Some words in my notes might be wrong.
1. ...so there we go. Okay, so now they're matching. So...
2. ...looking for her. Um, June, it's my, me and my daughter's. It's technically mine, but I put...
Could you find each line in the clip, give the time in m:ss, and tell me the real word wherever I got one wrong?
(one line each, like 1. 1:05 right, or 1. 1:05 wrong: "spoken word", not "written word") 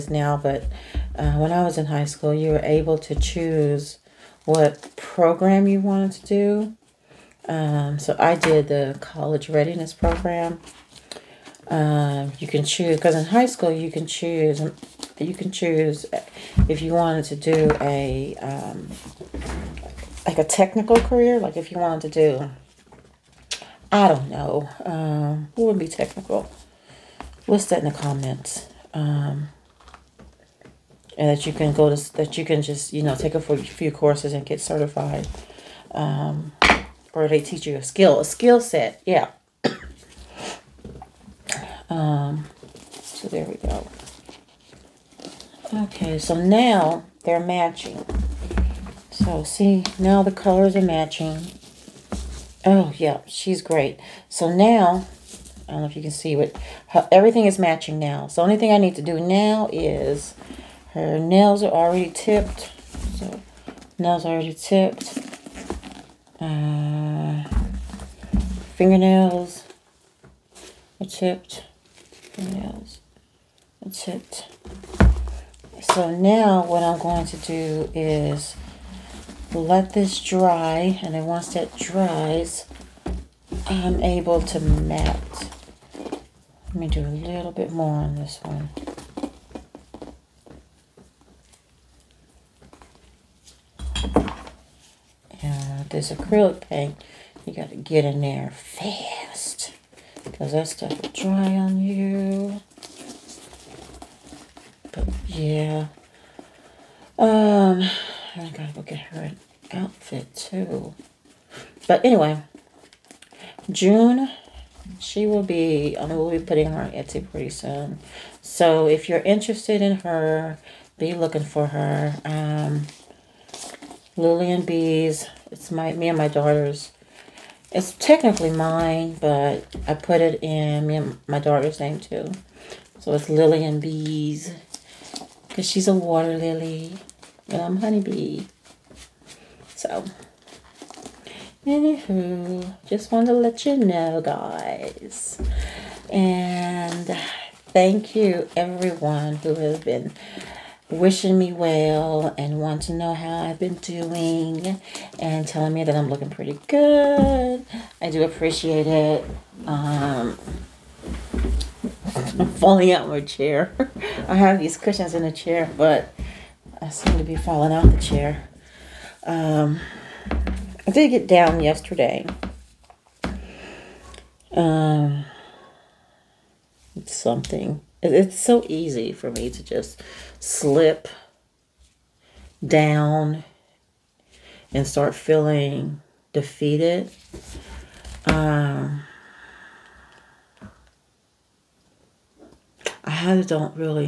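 1. 0:43 right
2. 2:01 wrong: "LilyNBees", not "June".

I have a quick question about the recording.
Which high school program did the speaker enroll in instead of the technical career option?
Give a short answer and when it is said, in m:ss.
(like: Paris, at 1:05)
college readiness program, at 0:09.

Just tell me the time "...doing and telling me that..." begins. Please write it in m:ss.
2:33.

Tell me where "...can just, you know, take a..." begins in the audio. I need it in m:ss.
0:32.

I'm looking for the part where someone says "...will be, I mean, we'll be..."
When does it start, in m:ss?
1:55.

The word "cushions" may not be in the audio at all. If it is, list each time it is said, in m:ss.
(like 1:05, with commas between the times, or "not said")
2:44.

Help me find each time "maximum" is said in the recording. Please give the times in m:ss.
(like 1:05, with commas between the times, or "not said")
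not said.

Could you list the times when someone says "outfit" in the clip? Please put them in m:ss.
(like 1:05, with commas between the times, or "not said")
1:49.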